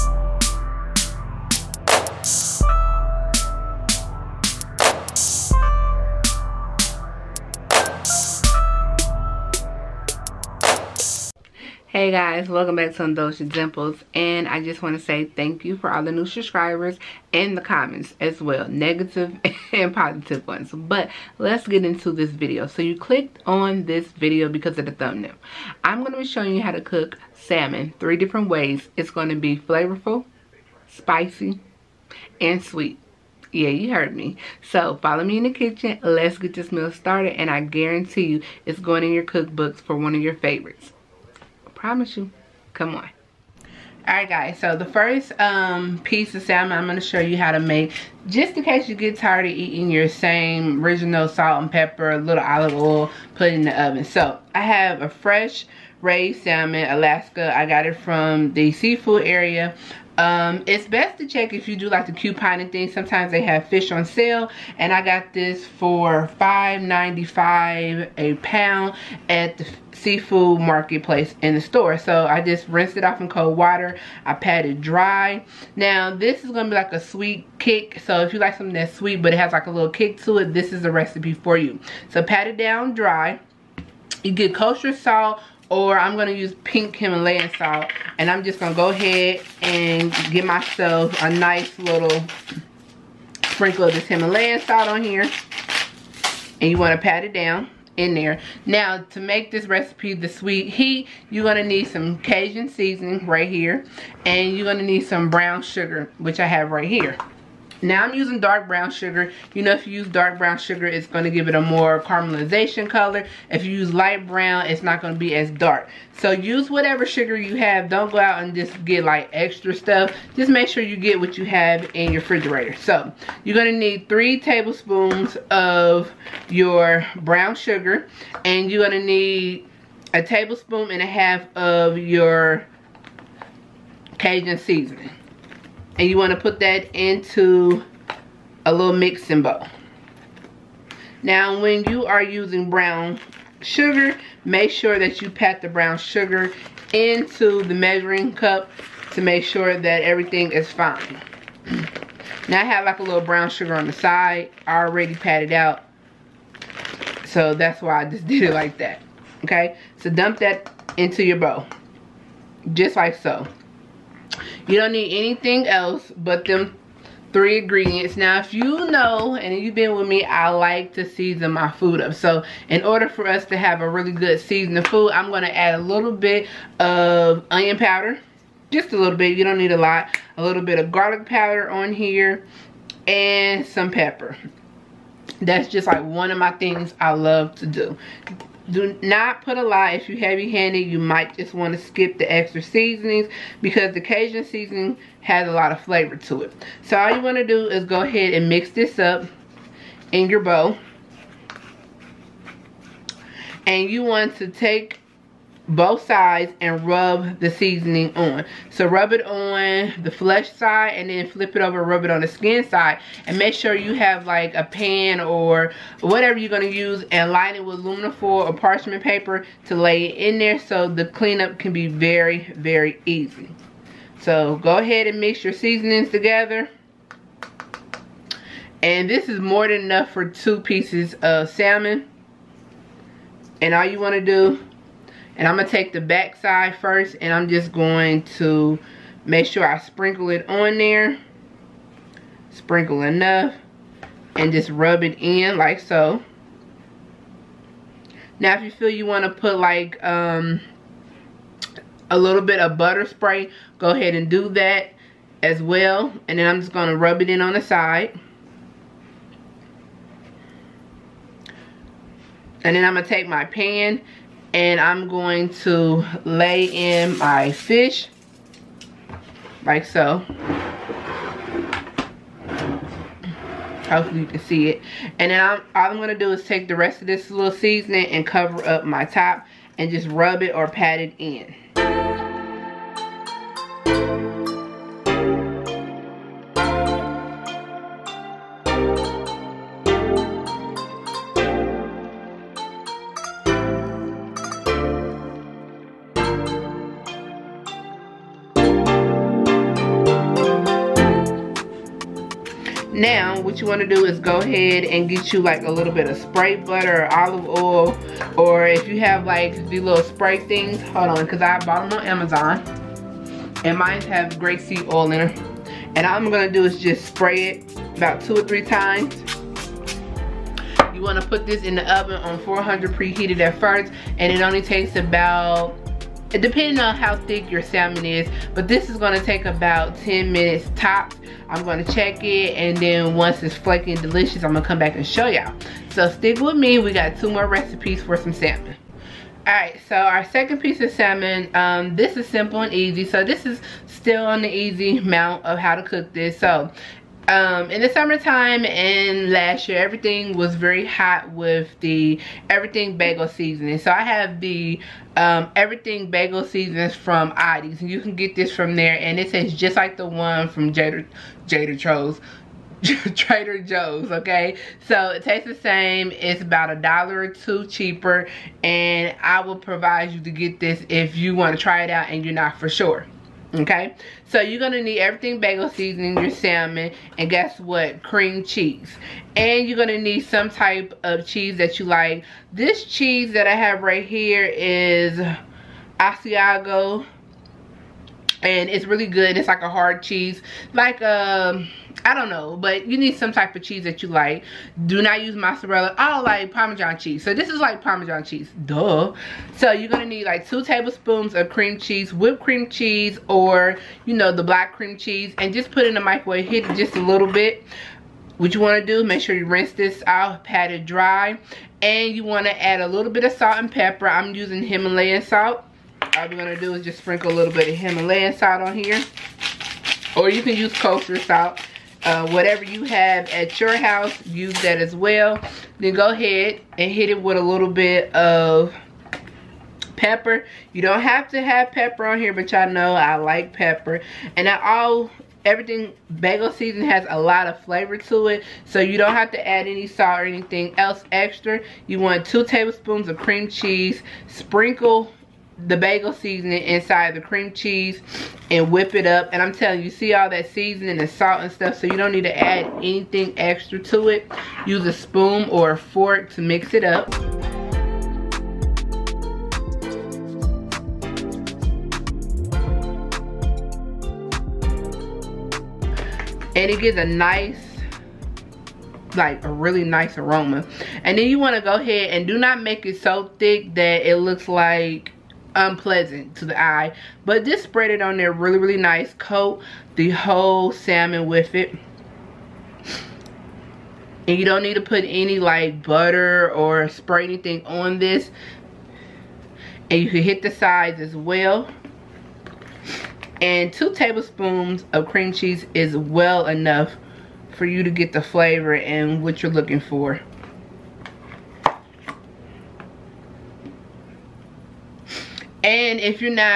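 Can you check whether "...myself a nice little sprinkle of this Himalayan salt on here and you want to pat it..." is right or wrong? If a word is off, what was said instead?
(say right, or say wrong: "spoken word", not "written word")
right.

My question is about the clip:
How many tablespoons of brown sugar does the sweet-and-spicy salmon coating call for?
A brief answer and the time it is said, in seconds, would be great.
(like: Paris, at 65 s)
3, at 124 s.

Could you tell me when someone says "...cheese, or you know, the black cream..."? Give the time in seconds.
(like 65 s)
402 s.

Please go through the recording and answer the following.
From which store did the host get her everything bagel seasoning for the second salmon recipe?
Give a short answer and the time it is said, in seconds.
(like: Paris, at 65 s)
Aldi's, at 357 s.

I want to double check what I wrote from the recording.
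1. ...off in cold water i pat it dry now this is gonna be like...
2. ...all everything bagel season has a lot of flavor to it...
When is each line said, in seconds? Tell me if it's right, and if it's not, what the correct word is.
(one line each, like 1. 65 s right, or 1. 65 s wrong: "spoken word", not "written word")
1. 73 s right
2. 434 s right.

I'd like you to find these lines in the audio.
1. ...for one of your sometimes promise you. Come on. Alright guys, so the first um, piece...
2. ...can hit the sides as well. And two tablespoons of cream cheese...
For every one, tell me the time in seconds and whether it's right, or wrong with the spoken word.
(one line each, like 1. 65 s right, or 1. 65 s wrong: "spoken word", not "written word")
1. 39 s wrong: "favorites", not "sometimes"
2. 490 s right.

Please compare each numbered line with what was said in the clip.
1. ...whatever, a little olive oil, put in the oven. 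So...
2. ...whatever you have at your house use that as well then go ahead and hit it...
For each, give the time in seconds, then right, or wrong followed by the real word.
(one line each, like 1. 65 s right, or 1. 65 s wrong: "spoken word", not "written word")
1. 51 s wrong: "pepper", not "whatever"
2. 422 s right.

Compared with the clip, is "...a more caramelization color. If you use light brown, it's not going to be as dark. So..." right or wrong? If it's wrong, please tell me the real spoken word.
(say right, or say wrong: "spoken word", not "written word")
right.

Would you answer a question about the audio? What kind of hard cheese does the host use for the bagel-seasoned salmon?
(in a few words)
Asiago.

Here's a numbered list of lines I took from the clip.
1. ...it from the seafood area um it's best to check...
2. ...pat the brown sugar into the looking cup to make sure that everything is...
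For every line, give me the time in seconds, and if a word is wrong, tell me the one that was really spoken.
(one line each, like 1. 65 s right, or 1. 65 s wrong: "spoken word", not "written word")
1. 57 s right
2. 145 s wrong: "measuring", not "looking".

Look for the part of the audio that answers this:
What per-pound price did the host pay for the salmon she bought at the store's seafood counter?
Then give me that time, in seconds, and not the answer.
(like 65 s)
66 s.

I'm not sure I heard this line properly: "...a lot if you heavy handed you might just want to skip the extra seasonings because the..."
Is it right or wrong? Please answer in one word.
right.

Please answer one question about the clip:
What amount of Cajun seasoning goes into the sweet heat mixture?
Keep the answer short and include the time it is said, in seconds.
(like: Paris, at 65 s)
1.5 tablespoons, at 130 s.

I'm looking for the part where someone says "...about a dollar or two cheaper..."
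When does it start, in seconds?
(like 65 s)
366 s.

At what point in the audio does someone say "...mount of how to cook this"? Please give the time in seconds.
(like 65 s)
345 s.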